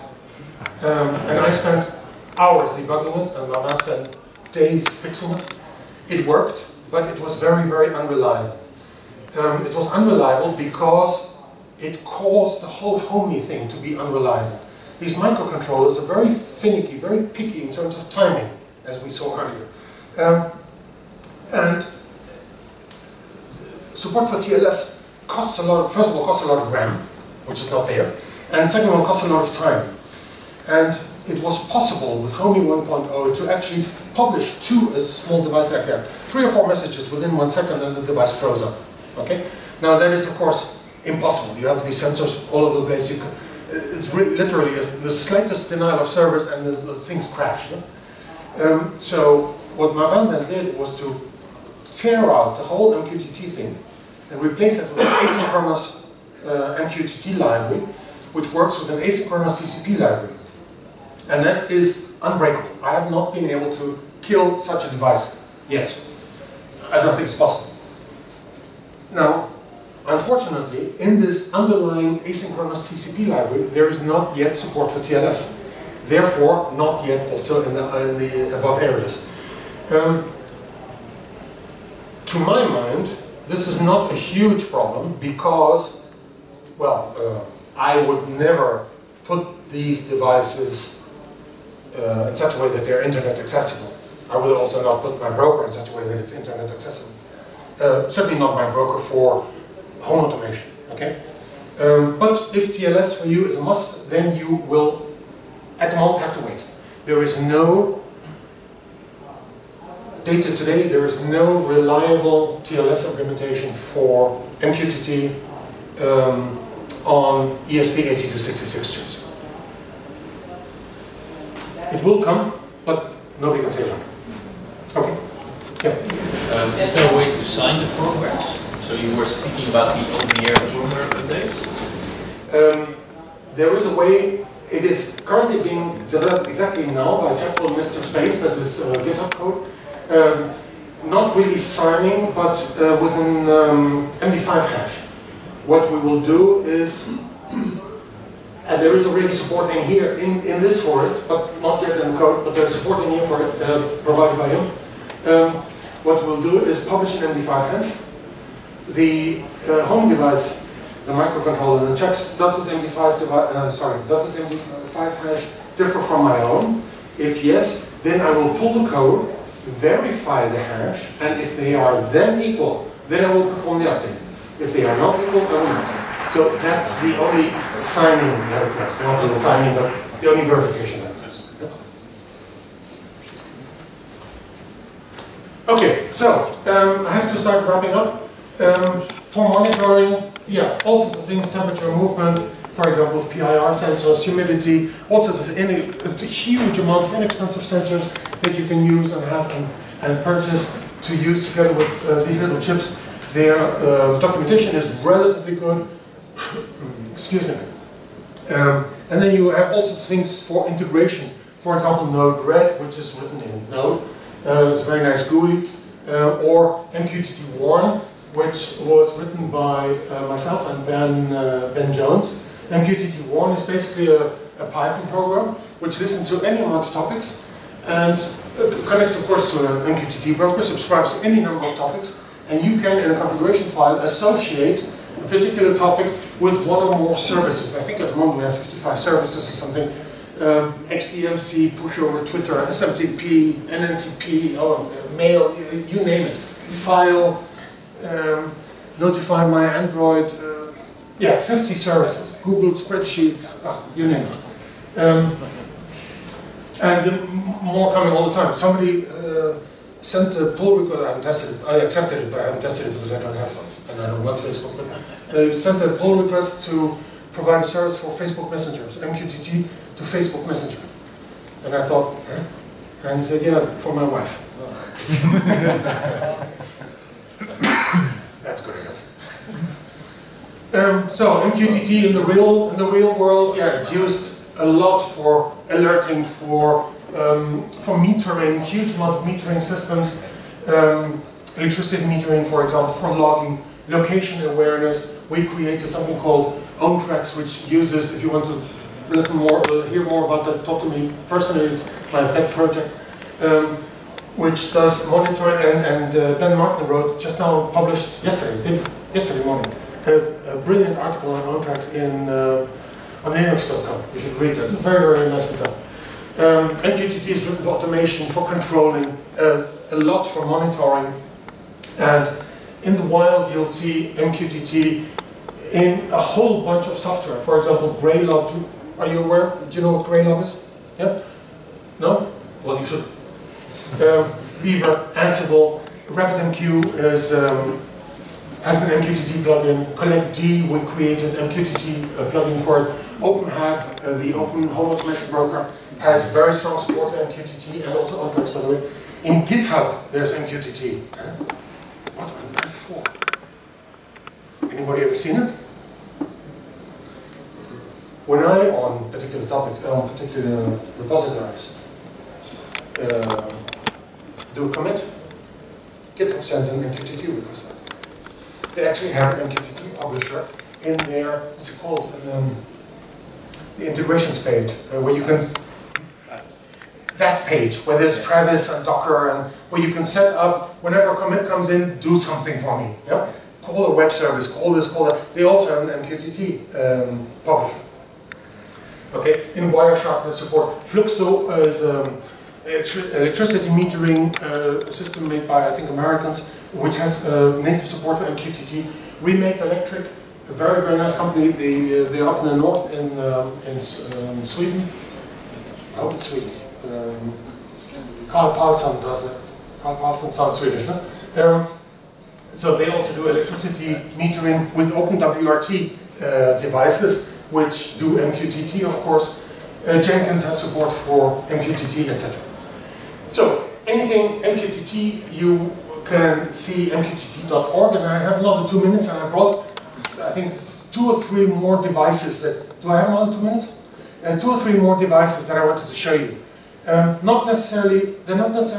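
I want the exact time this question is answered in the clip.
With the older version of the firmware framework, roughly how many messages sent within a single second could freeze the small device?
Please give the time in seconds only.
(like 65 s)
36 s.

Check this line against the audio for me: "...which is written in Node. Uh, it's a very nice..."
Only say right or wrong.
right.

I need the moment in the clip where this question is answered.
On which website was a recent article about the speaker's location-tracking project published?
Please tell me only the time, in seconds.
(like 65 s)
313 s.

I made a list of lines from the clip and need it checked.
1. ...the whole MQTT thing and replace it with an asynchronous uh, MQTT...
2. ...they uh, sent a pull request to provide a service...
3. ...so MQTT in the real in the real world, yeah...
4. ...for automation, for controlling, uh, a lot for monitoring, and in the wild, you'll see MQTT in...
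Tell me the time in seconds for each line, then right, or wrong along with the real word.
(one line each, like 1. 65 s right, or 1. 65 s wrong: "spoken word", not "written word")
1. 52 s right
2. 265 s right
3. 281 s right
4. 317 s right.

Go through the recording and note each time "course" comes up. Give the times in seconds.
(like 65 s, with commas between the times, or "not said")
40 s, 229 s, 418 s.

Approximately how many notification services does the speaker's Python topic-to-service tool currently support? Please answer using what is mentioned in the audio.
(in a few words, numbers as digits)
55.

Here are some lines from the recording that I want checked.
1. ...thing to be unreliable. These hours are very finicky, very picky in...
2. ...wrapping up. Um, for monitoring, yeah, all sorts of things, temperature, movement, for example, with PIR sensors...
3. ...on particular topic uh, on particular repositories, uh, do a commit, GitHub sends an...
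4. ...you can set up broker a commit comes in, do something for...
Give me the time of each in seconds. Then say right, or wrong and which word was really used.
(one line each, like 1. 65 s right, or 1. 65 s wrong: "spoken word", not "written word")
1. 13 s wrong: "microcontrollers", not "hours"
2. 187 s right
3. 358 s right
4. 379 s wrong: "whenever", not "broker".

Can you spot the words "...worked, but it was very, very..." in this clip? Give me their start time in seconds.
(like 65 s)
6 s.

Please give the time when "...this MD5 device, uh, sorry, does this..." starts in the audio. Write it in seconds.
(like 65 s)
162 s.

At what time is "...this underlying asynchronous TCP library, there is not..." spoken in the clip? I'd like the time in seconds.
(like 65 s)
71 s.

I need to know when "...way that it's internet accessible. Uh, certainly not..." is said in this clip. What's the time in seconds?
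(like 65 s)
95 s.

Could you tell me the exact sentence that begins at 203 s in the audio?
Their uh, documentation is relatively good.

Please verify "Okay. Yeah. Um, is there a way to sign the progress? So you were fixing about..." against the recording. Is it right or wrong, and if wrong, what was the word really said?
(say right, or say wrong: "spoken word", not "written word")
wrong: "speaking", not "fixing".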